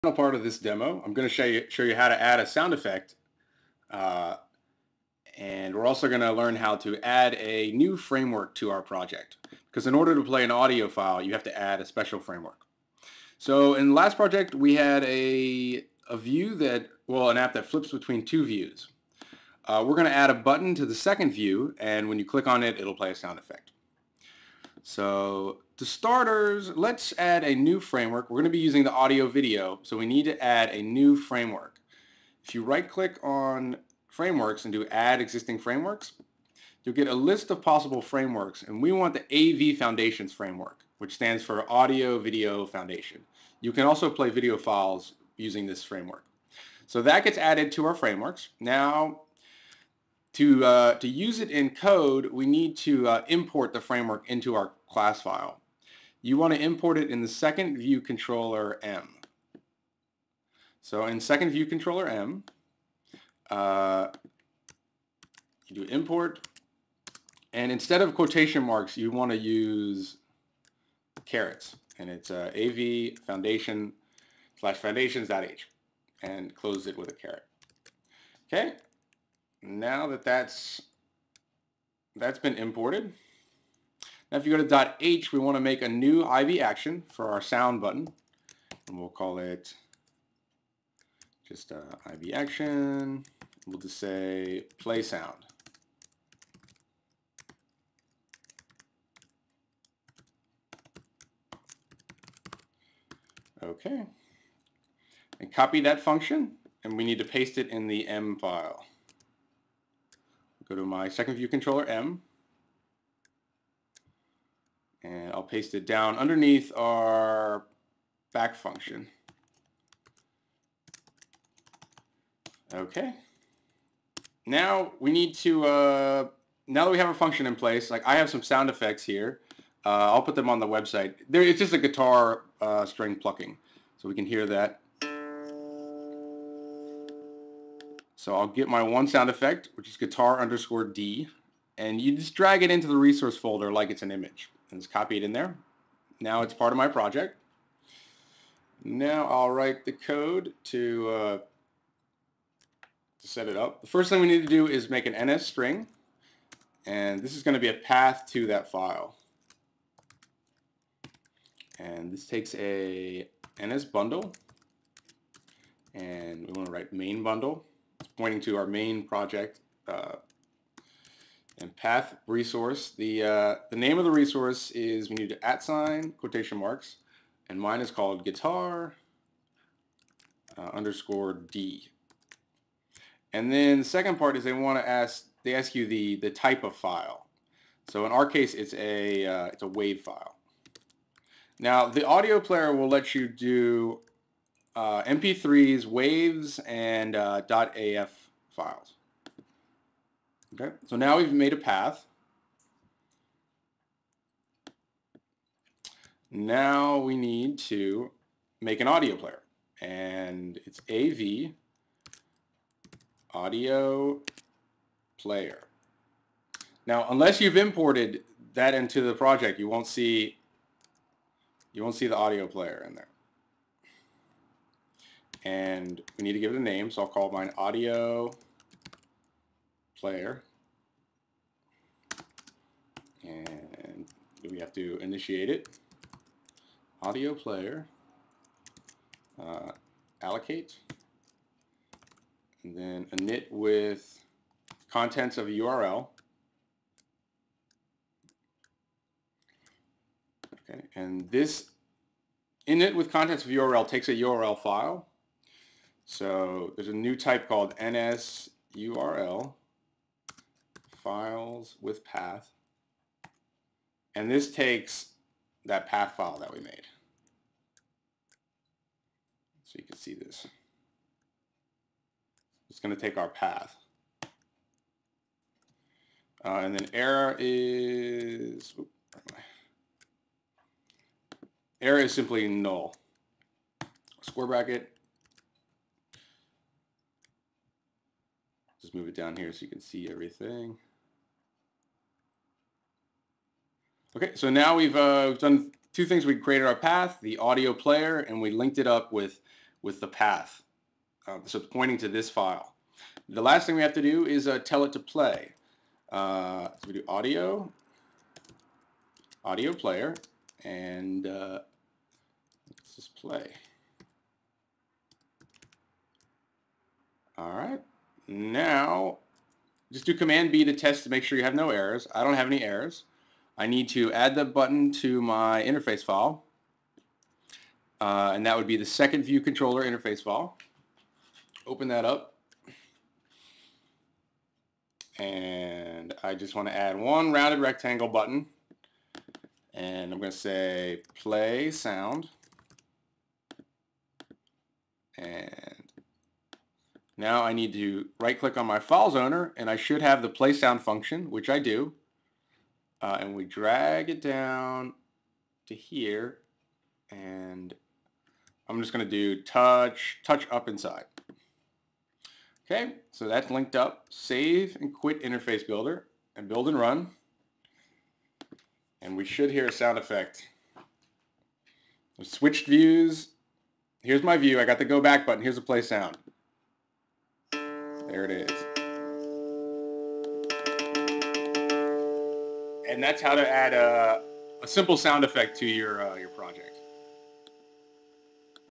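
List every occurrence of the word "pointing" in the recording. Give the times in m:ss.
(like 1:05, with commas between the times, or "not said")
2:48, 5:01.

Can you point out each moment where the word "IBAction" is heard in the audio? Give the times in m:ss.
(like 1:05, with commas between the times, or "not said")
1:26, 1:32.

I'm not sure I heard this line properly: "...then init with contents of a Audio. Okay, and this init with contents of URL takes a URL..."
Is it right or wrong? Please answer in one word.
wrong.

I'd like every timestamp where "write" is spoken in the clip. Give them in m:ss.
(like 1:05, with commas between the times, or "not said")
2:29, 2:46.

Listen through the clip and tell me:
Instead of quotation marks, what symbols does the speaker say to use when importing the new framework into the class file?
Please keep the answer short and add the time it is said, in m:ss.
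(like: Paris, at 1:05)
carets, at 1:11.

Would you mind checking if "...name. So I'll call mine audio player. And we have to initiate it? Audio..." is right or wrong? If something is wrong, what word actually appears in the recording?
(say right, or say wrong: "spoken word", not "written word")
right.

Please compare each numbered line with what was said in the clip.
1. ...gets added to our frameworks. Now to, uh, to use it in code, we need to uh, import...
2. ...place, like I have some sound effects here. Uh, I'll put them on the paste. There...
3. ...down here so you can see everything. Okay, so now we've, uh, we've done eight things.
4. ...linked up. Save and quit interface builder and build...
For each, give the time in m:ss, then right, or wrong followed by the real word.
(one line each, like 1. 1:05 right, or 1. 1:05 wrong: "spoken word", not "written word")
1. 0:47 right
2. 2:07 wrong: "website", not "paste"
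3. 4:49 wrong: "two", not "eight"
4. 6:03 right.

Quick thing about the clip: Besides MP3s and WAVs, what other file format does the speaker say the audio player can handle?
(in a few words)
.af files.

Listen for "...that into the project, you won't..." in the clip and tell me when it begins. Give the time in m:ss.
3:38.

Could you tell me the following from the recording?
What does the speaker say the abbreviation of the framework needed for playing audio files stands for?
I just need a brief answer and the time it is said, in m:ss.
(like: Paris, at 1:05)
Audio Video Foundation, at 0:41.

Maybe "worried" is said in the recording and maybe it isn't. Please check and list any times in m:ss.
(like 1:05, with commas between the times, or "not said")
not said.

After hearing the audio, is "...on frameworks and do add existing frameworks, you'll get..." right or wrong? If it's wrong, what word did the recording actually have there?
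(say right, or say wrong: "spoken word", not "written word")
right.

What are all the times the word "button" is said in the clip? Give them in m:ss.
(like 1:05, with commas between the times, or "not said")
0:20, 1:27, 5:24, 5:38, 6:15.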